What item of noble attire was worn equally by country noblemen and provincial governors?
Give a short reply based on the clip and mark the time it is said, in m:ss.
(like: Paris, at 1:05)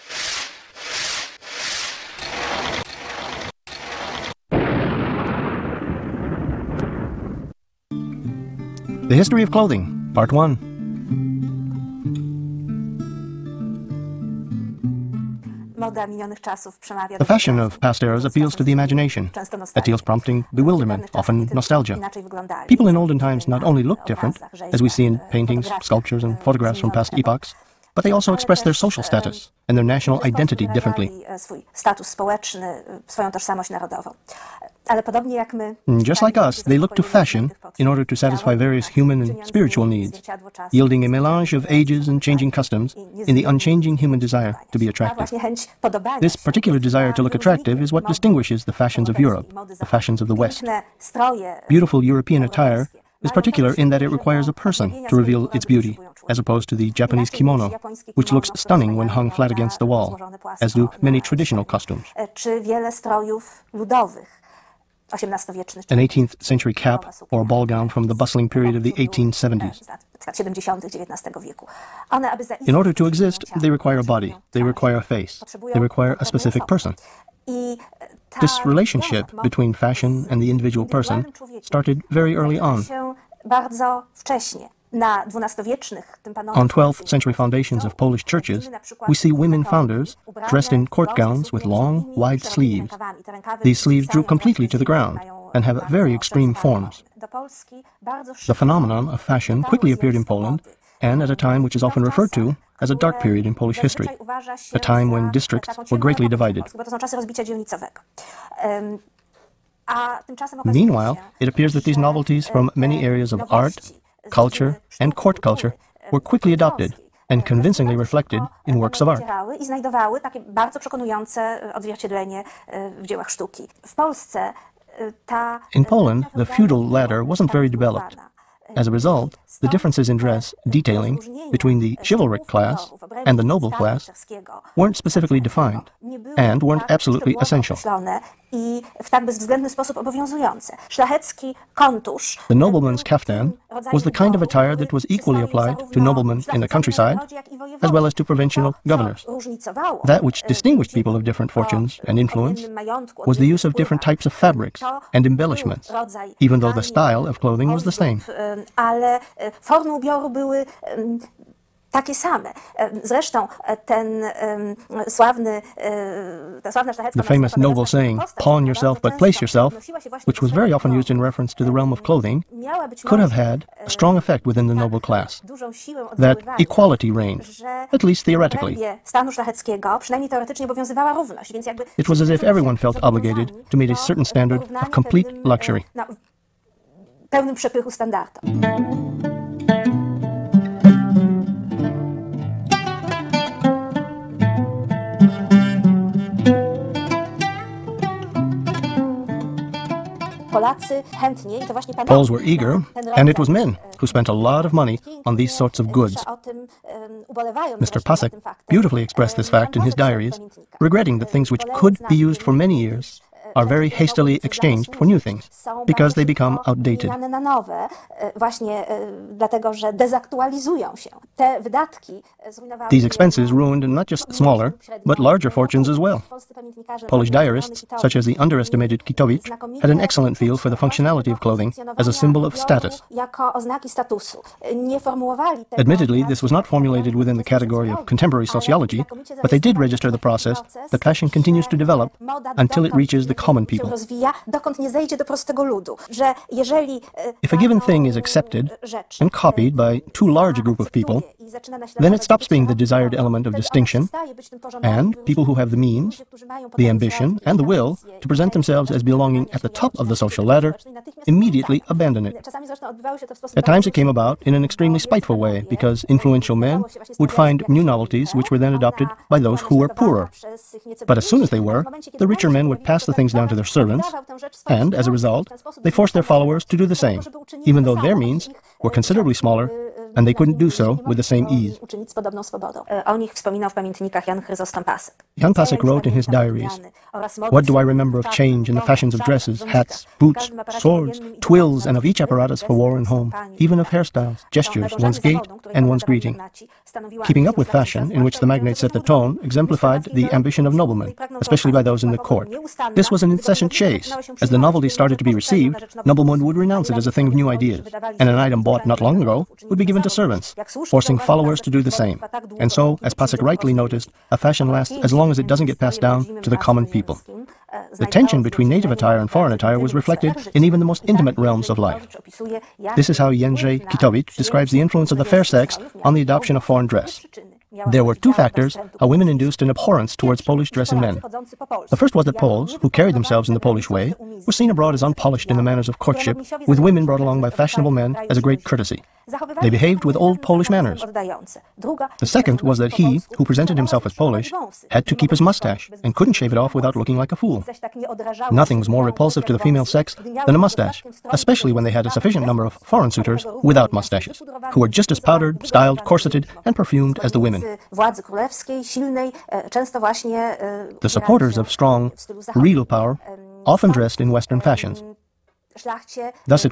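kaftan, at 2:23.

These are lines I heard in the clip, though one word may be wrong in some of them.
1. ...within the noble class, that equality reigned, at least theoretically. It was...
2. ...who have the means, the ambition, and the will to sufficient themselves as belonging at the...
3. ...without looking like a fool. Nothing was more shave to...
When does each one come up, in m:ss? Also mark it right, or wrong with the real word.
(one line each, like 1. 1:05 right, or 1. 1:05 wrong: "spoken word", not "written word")
1. 2:54 right
2. 4:15 wrong: "present", not "sufficient"
3. 5:46 wrong: "repulsive", not "shave".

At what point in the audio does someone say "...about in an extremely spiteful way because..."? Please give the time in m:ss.
4:24.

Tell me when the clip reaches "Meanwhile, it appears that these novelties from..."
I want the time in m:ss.
1:50.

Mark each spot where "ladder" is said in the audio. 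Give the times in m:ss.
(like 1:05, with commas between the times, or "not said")
2:06, 4:20.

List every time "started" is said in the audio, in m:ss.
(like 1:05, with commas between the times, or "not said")
1:21, 5:04.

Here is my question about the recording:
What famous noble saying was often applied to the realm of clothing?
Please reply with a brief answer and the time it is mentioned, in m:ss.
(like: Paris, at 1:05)
pawn yourself but place yourself, at 2:48.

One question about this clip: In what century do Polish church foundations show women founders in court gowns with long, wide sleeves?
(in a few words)
12th century.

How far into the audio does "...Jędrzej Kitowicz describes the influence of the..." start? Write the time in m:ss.
5:23.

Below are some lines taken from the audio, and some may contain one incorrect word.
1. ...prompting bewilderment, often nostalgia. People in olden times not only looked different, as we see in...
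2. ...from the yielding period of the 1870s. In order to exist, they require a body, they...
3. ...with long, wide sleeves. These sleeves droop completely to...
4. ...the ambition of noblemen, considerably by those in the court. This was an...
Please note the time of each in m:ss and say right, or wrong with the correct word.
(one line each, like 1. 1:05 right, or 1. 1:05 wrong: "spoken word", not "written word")
1. 0:20 right
2. 1:07 wrong: "bustling", not "yielding"
3. 1:31 right
4. 5:00 wrong: "especially", not "considerably".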